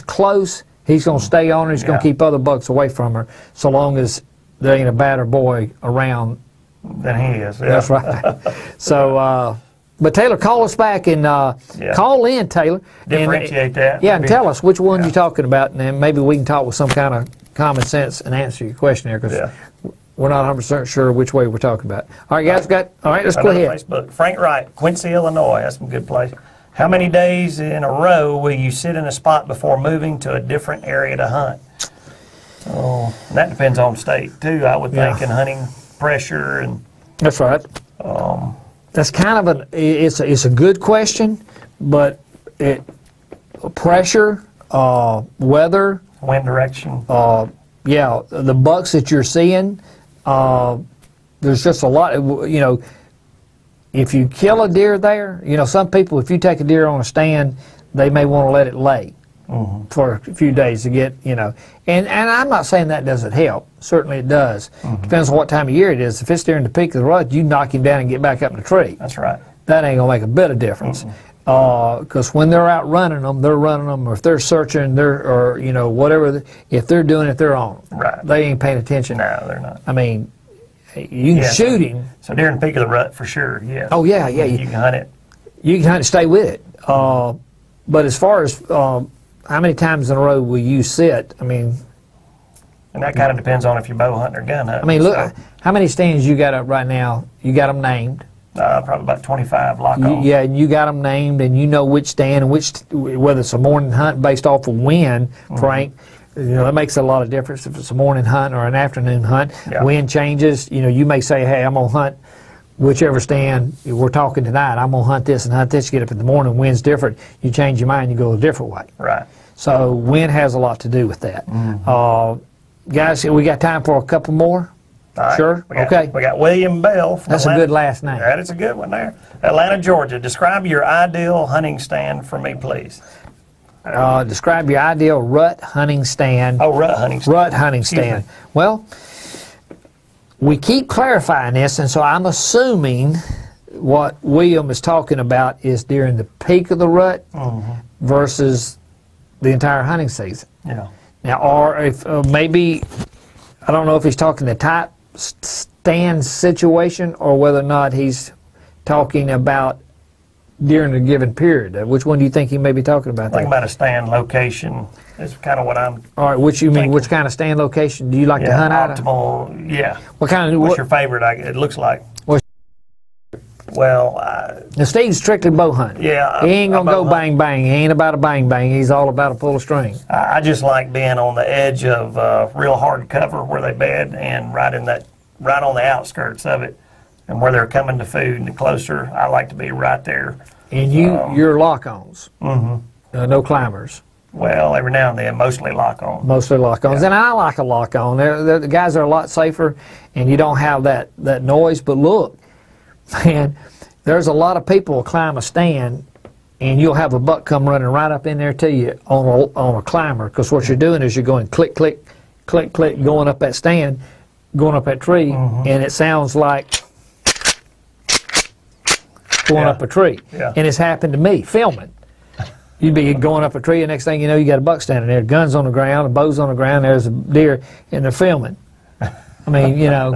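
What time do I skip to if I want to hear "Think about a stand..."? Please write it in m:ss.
2:43.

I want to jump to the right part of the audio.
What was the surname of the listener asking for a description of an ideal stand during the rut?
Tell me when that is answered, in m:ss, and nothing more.
2:06.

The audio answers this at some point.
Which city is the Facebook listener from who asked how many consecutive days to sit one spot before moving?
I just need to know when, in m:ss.
0:24.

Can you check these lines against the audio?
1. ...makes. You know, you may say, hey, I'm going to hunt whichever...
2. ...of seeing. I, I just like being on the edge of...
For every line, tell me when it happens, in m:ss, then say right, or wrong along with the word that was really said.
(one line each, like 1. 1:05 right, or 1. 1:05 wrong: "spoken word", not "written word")
1. 1:50 wrong: "changes", not "makes"
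2. 2:59 wrong: "string", not "seeing".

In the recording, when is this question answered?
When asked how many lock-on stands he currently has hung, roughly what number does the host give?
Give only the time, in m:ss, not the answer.
1:39.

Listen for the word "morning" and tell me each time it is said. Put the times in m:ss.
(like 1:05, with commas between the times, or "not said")
1:43, 1:47, 1:56.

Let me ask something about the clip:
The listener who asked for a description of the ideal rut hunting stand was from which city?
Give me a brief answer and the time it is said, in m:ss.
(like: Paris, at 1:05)
Atlanta, Georgia, at 2:09.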